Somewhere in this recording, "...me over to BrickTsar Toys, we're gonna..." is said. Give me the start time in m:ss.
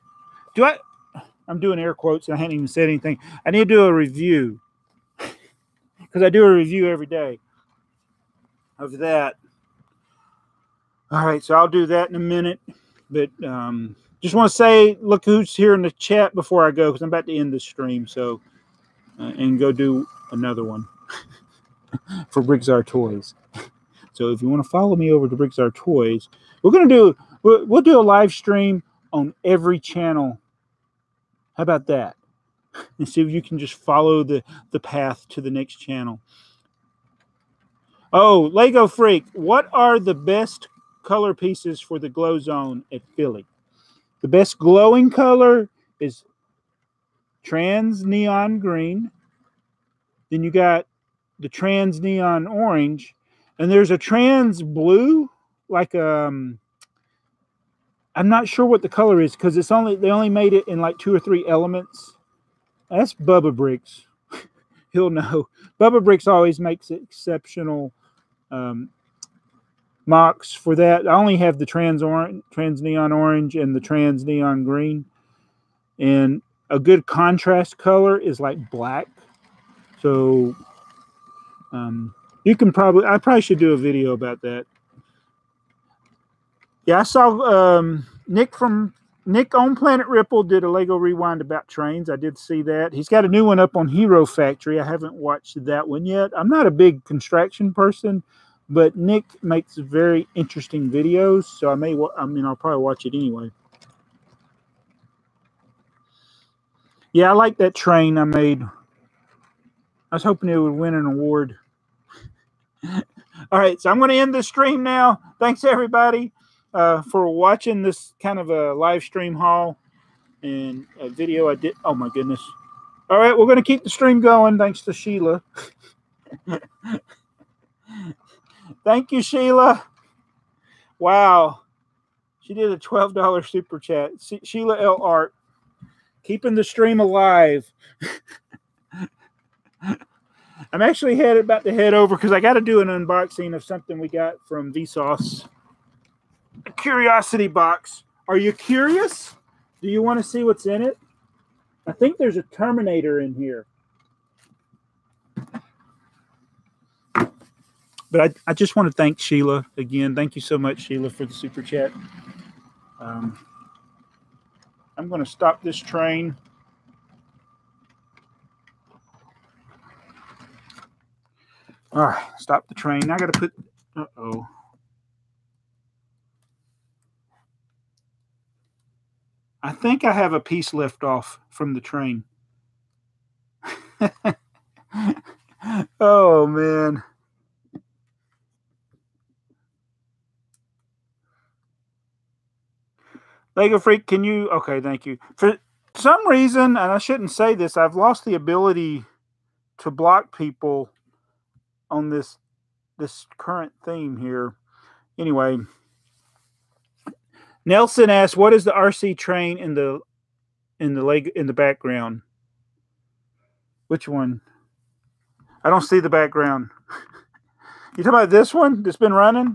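0:24.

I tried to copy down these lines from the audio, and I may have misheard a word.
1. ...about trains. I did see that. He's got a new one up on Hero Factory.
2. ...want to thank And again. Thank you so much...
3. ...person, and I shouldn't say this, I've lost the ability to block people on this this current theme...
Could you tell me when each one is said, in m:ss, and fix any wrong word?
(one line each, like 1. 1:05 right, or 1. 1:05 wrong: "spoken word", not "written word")
1. 1:31 right
2. 2:38 wrong: "Sheila", not "And"
3. 3:16 wrong: "reason", not "person".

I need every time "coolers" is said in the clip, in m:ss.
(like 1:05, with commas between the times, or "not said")
not said.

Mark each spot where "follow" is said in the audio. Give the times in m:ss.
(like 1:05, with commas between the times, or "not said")
0:24, 0:33.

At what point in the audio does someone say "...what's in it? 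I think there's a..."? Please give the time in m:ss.
2:30.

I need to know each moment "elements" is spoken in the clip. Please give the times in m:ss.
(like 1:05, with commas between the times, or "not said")
1:01.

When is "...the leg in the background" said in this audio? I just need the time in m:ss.
3:30.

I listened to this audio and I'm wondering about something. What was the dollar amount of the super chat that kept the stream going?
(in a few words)
12.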